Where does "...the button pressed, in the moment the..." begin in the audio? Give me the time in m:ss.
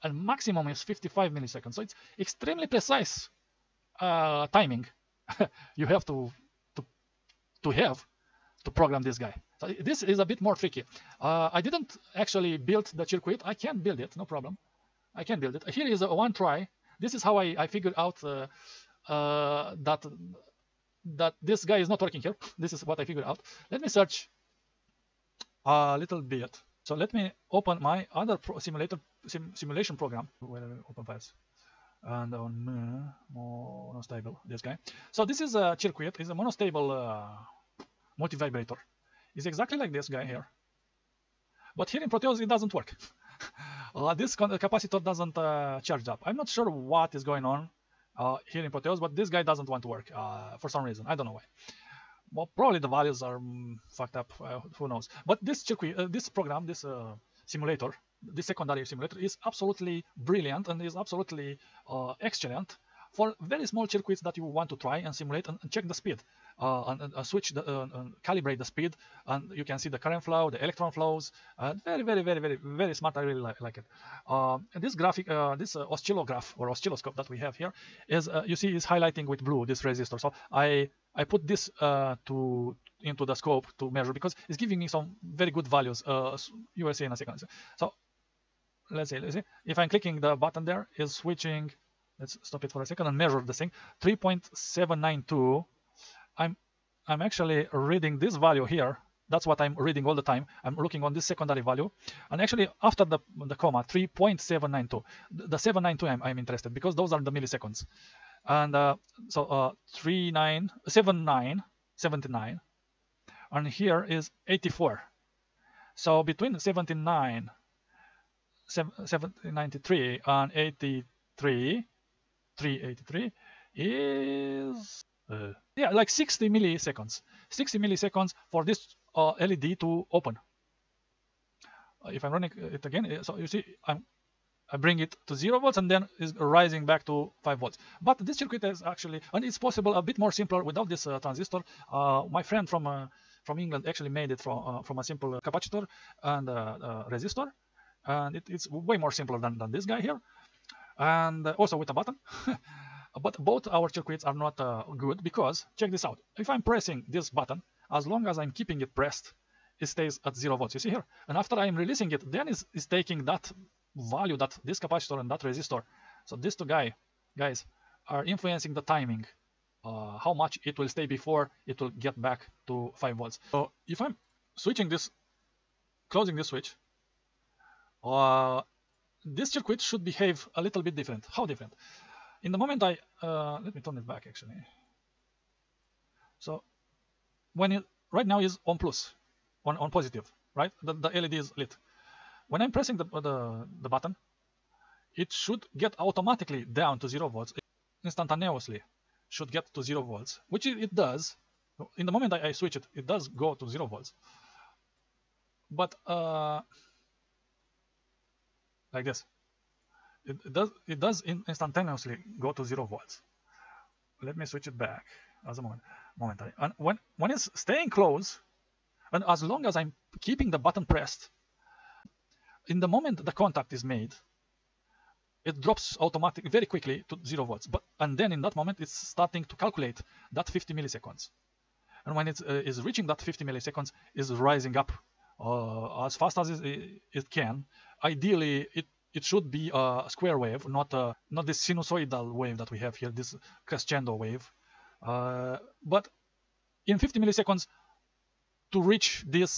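3:40.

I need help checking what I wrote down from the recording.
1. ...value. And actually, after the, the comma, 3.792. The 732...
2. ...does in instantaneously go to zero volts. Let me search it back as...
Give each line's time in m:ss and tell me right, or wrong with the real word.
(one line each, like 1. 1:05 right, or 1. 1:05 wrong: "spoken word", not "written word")
1. 1:41 wrong: "792", not "732"
2. 3:30 wrong: "switch", not "search".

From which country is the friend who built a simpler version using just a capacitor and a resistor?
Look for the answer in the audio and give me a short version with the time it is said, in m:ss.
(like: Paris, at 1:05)
England, at 2:23.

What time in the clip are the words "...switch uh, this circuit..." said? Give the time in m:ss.
2:56.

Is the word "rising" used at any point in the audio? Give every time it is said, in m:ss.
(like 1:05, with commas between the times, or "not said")
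2:16, 3:54.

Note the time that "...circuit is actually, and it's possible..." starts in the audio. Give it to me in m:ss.
2:18.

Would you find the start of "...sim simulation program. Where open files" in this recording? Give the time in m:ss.
0:29.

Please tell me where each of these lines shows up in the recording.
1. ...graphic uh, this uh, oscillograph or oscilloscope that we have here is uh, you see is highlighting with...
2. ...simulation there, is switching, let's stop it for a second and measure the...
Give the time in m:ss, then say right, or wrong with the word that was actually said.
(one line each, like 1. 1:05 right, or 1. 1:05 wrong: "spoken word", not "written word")
1. 1:14 right
2. 1:30 wrong: "button", not "simulation".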